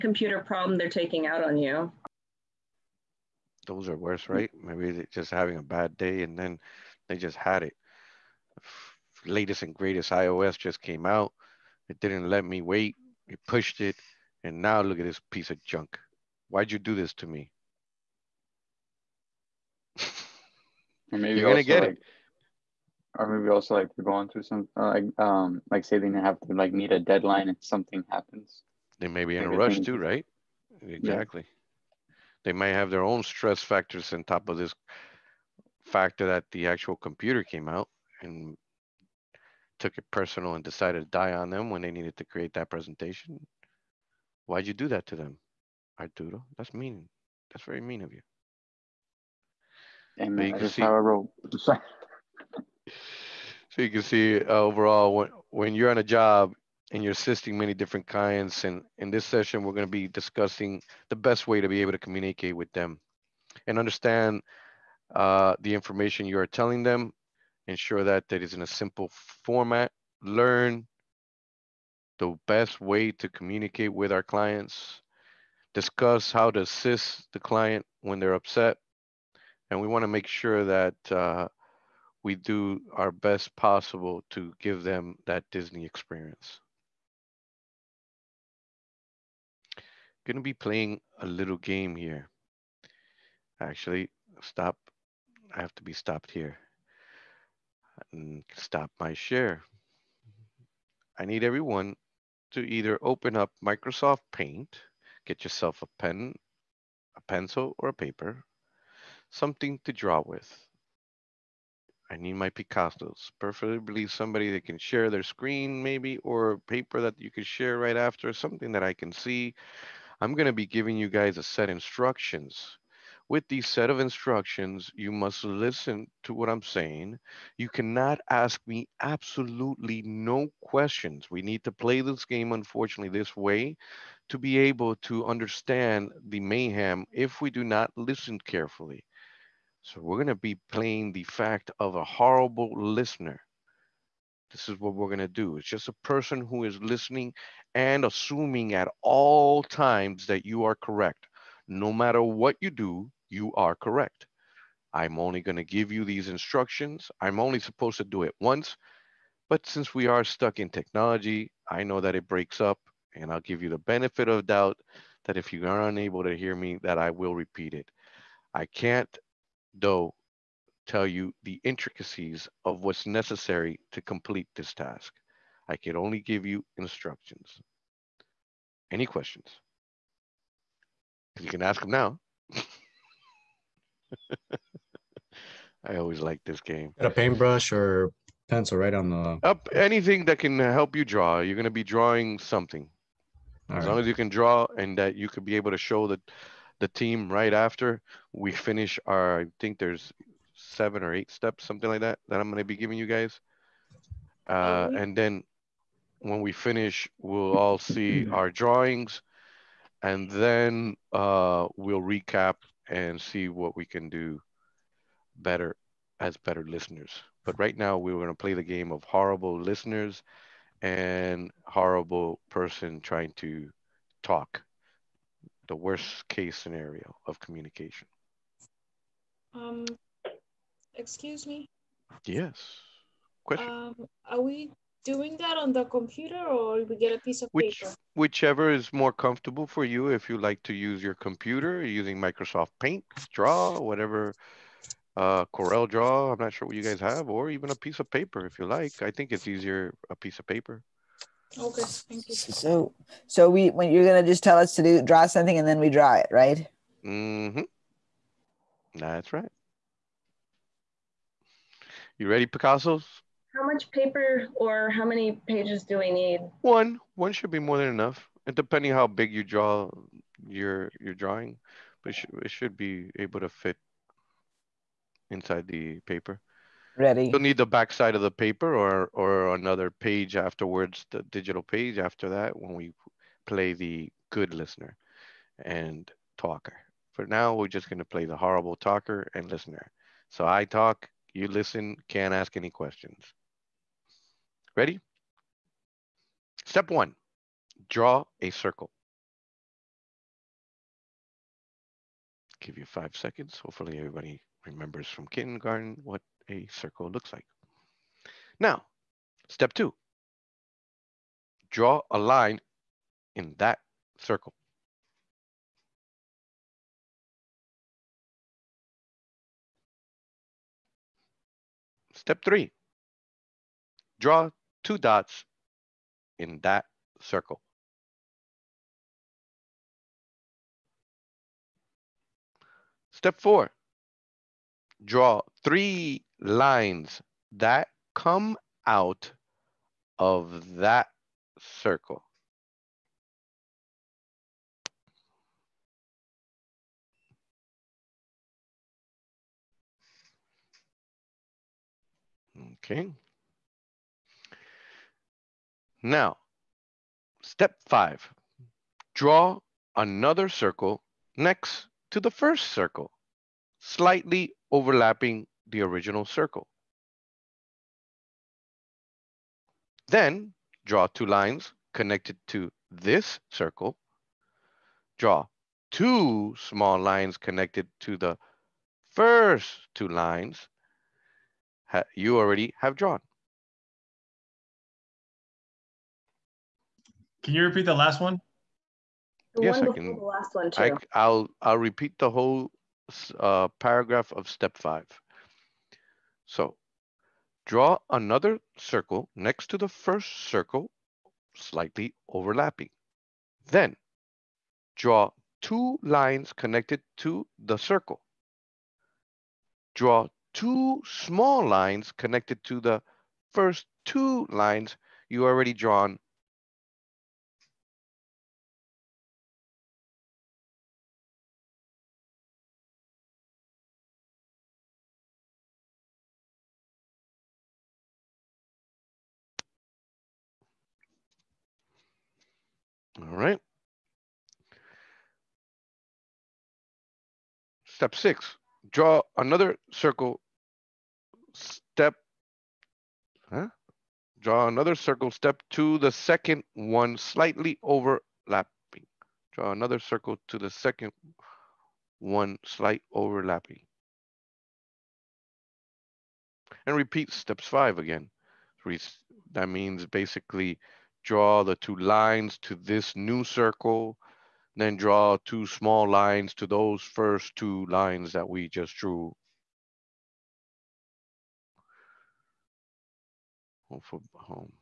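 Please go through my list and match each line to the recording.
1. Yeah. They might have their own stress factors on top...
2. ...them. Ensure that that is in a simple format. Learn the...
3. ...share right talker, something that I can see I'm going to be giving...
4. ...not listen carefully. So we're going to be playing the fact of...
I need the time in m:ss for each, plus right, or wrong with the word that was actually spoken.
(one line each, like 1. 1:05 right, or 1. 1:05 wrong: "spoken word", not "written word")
1. 0:31 right
2. 1:06 right
3. 1:57 wrong: "after", not "talker"
4. 2:17 right.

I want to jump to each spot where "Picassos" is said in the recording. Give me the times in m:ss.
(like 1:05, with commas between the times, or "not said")
1:52, 4:22.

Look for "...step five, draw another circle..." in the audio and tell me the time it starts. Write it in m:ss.
5:57.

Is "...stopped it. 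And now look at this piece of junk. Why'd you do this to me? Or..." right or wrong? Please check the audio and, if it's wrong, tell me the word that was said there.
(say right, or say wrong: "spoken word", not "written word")
wrong: "pushed", not "stopped".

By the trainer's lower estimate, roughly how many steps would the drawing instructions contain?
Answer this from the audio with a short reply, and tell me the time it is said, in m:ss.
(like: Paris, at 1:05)
7, at 3:20.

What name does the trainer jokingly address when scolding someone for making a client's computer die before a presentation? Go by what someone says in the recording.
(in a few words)
Arturo.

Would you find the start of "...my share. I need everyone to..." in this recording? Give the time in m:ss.
1:38.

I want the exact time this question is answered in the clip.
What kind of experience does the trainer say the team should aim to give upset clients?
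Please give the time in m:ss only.
1:25.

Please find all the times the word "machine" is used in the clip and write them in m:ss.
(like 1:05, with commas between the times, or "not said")
not said.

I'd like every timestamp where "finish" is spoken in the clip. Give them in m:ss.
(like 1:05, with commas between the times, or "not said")
3:18, 3:26.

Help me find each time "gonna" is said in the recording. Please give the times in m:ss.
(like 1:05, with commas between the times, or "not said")
0:21, 4:14, 4:47.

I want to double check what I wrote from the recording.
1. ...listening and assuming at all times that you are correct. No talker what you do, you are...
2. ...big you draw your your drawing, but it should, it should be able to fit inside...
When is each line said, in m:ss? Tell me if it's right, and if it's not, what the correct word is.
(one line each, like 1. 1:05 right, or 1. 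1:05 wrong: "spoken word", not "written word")
1. 2:26 wrong: "matter", not "talker"
2. 4:29 right.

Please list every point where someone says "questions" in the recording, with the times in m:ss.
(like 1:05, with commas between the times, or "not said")
2:10, 2:59, 3:53, 4:52.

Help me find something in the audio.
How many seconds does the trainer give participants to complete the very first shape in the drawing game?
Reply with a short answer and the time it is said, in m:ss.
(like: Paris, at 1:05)
5, at 5:02.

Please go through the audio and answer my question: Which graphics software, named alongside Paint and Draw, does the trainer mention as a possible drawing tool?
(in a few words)
Corel Draw.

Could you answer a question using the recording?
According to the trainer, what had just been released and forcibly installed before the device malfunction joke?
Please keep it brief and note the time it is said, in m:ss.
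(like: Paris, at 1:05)
iOS, at 0:10.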